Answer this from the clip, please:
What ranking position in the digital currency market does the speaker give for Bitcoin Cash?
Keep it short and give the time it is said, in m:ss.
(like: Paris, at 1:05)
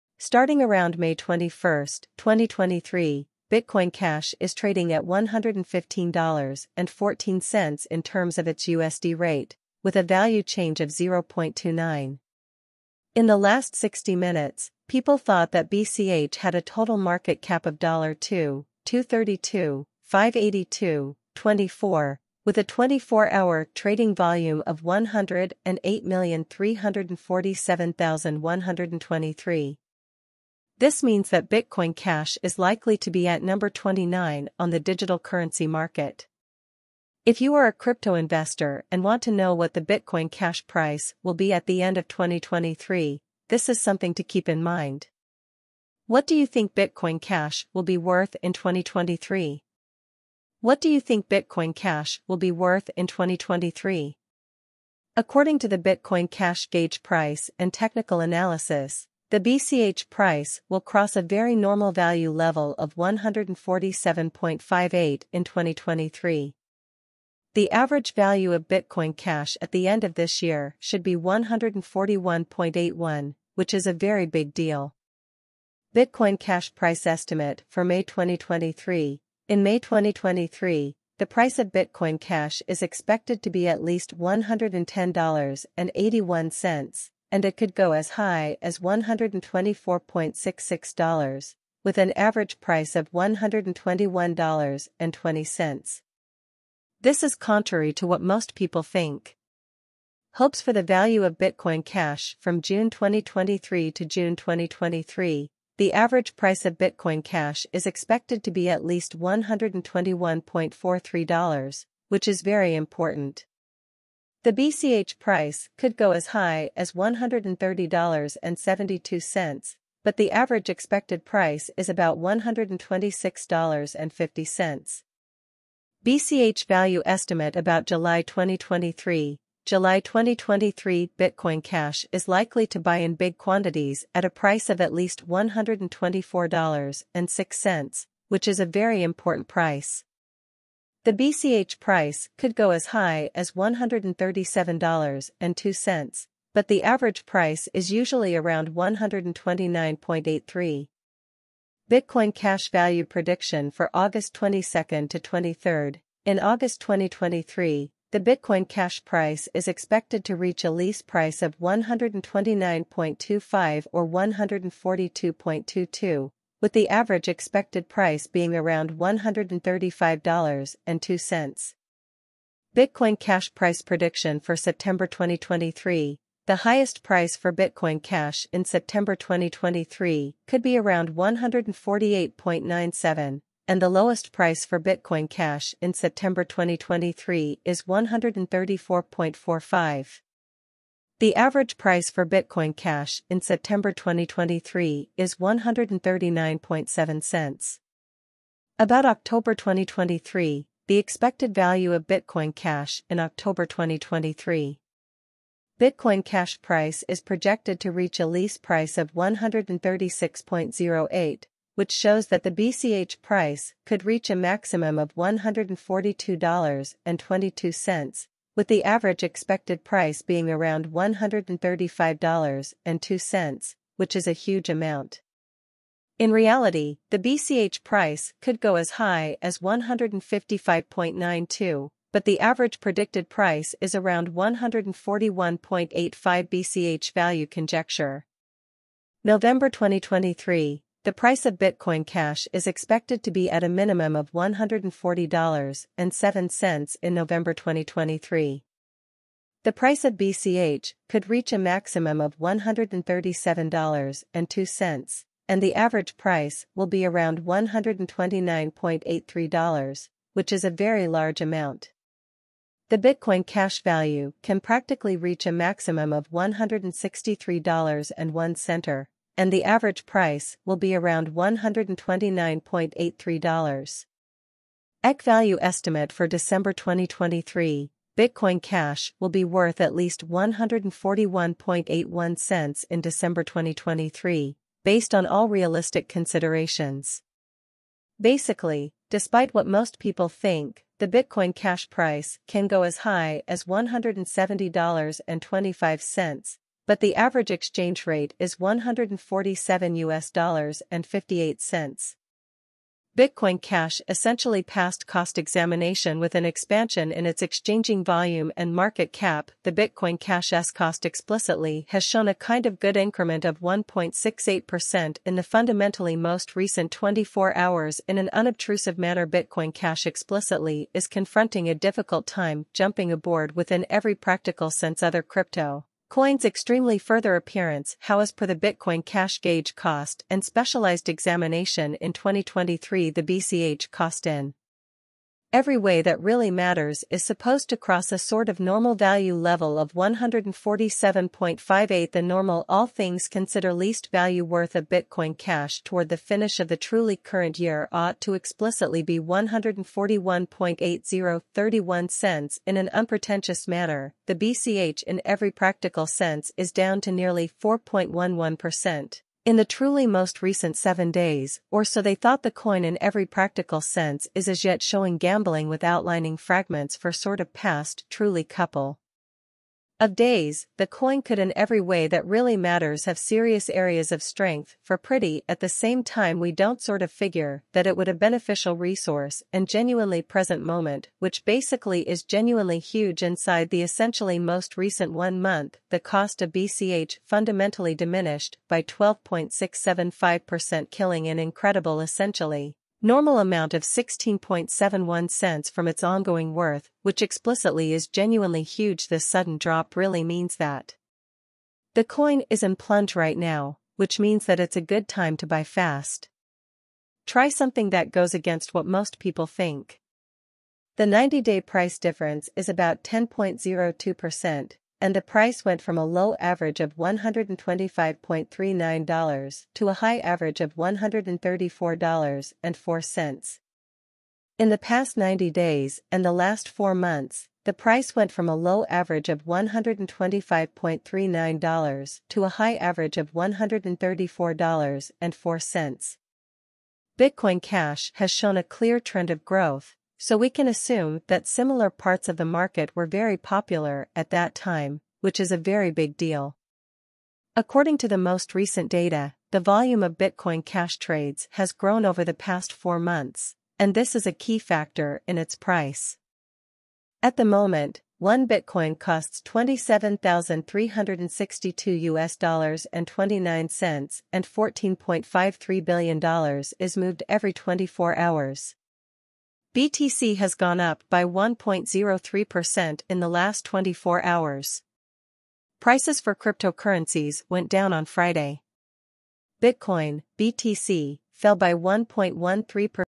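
29, at 0:33.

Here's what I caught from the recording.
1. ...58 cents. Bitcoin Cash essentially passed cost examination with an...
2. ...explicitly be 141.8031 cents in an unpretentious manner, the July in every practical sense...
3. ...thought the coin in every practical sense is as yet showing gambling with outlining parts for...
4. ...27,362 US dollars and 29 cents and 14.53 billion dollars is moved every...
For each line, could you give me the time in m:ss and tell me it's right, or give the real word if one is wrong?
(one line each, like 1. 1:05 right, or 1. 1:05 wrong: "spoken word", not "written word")
1. 5:01 right
2. 5:48 wrong: "BCH", not "July"
3. 6:02 wrong: "fragments", not "parts"
4. 7:39 right.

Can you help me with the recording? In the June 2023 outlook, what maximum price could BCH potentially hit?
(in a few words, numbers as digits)
$130.72.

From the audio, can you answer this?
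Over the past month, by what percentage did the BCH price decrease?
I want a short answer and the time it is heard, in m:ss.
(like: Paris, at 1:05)
12.675%, at 6:28.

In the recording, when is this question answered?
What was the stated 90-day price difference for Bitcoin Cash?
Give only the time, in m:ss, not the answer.
6:53.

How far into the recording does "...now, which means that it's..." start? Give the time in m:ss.
6:43.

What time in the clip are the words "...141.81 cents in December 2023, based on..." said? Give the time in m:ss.
4:40.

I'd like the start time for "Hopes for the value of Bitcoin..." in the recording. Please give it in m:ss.
1:40.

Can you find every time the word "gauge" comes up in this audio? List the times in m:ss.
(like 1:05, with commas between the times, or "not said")
0:56, 5:29.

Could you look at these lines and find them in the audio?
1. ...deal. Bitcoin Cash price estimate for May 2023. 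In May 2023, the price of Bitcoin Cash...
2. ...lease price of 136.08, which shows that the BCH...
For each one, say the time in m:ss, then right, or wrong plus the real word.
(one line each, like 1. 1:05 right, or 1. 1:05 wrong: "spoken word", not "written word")
1. 1:14 right
2. 3:28 right.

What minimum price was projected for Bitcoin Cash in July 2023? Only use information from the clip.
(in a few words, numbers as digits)
$124.06.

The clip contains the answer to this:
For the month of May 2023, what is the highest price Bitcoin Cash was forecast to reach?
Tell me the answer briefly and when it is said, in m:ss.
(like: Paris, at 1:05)
$124.66, at 1:28.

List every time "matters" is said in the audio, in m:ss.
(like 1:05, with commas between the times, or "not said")
5:36, 6:12.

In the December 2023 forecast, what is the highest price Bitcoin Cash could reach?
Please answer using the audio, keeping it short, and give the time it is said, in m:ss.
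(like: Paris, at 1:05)
$170.25, at 4:53.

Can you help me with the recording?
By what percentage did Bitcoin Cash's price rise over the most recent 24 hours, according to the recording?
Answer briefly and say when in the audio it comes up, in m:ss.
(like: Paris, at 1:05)
1.68%, at 5:13.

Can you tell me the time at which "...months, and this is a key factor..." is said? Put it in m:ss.
7:32.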